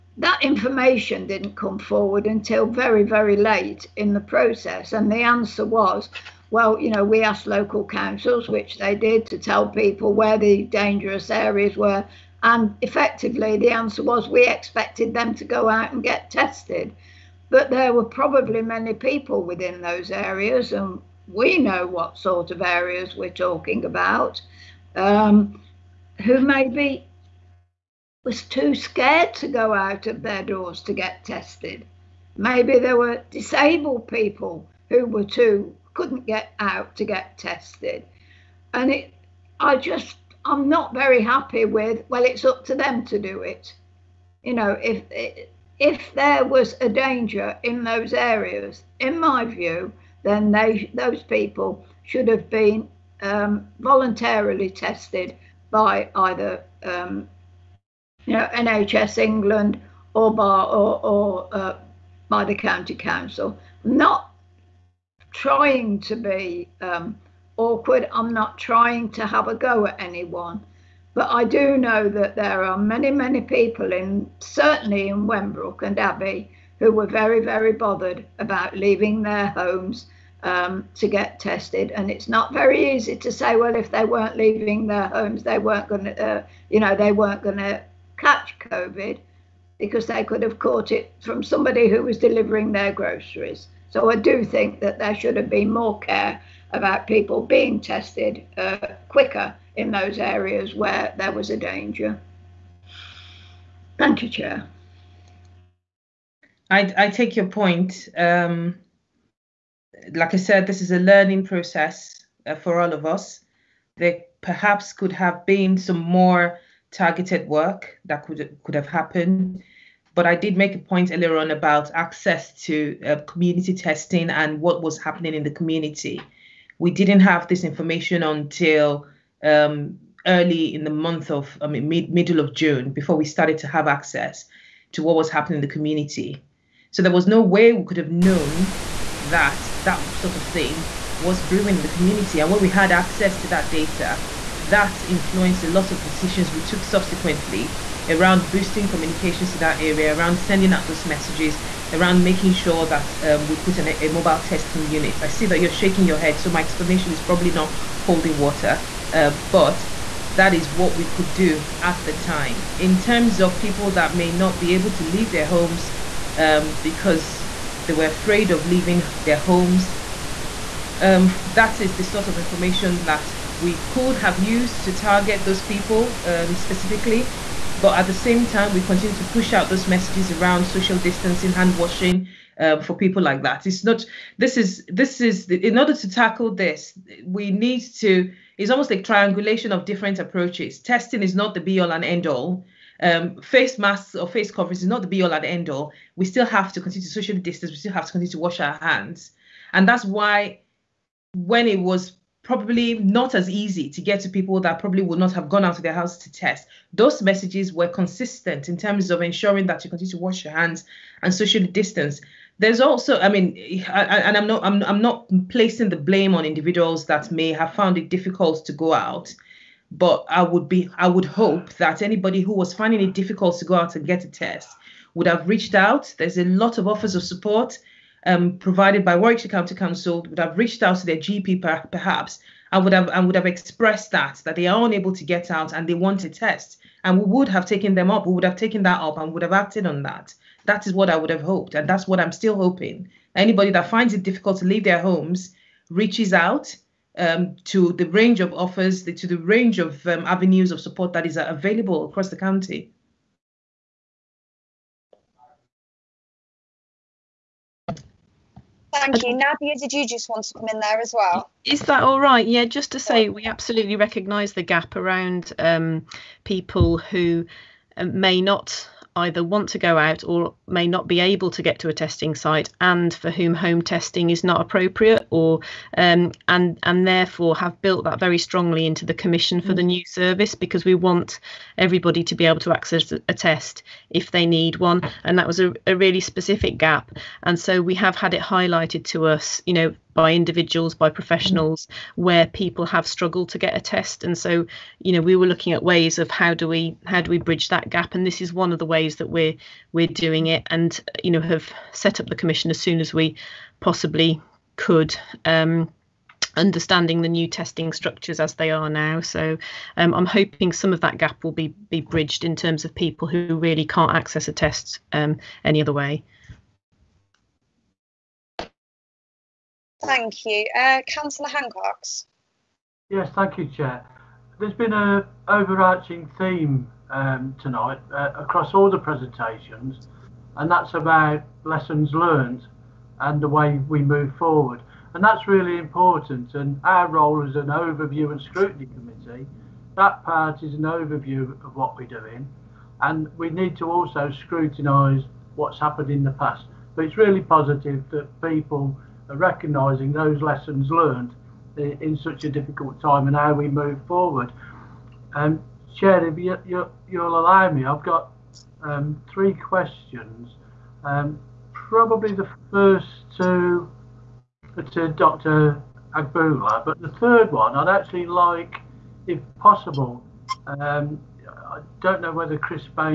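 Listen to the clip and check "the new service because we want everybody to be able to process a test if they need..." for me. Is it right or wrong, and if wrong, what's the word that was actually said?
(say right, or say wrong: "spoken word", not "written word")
wrong: "access", not "process".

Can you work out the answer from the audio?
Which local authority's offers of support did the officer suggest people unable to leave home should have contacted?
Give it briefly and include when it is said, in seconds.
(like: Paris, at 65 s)
Warwickshire County Council, at 229 s.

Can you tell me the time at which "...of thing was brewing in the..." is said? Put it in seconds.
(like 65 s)
140 s.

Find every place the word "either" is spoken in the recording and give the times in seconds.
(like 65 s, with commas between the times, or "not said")
56 s, 269 s.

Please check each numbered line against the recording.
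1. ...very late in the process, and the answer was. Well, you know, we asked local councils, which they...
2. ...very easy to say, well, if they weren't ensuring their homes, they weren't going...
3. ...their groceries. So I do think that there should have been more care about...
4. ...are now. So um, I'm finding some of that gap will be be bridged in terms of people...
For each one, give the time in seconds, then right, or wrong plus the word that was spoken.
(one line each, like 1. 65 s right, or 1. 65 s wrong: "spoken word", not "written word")
1. 3 s right
2. 82 s wrong: "leaving", not "ensuring"
3. 92 s right
4. 308 s wrong: "hoping", not "finding".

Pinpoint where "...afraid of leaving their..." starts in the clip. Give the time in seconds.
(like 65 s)
168 s.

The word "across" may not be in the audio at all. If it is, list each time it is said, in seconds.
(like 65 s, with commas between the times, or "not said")
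252 s, 328 s.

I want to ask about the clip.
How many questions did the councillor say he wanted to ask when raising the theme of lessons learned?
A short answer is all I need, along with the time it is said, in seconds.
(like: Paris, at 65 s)
3, at 359 s.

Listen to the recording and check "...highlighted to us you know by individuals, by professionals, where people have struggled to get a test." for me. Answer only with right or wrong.
right.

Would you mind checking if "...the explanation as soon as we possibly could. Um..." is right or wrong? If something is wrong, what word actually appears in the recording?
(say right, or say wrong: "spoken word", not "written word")
wrong: "commission", not "explanation".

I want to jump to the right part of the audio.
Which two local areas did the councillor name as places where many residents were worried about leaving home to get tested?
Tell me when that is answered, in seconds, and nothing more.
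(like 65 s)
75 s.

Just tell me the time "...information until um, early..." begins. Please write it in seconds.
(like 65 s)
127 s.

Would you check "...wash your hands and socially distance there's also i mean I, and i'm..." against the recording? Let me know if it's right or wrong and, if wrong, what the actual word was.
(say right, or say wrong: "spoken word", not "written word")
right.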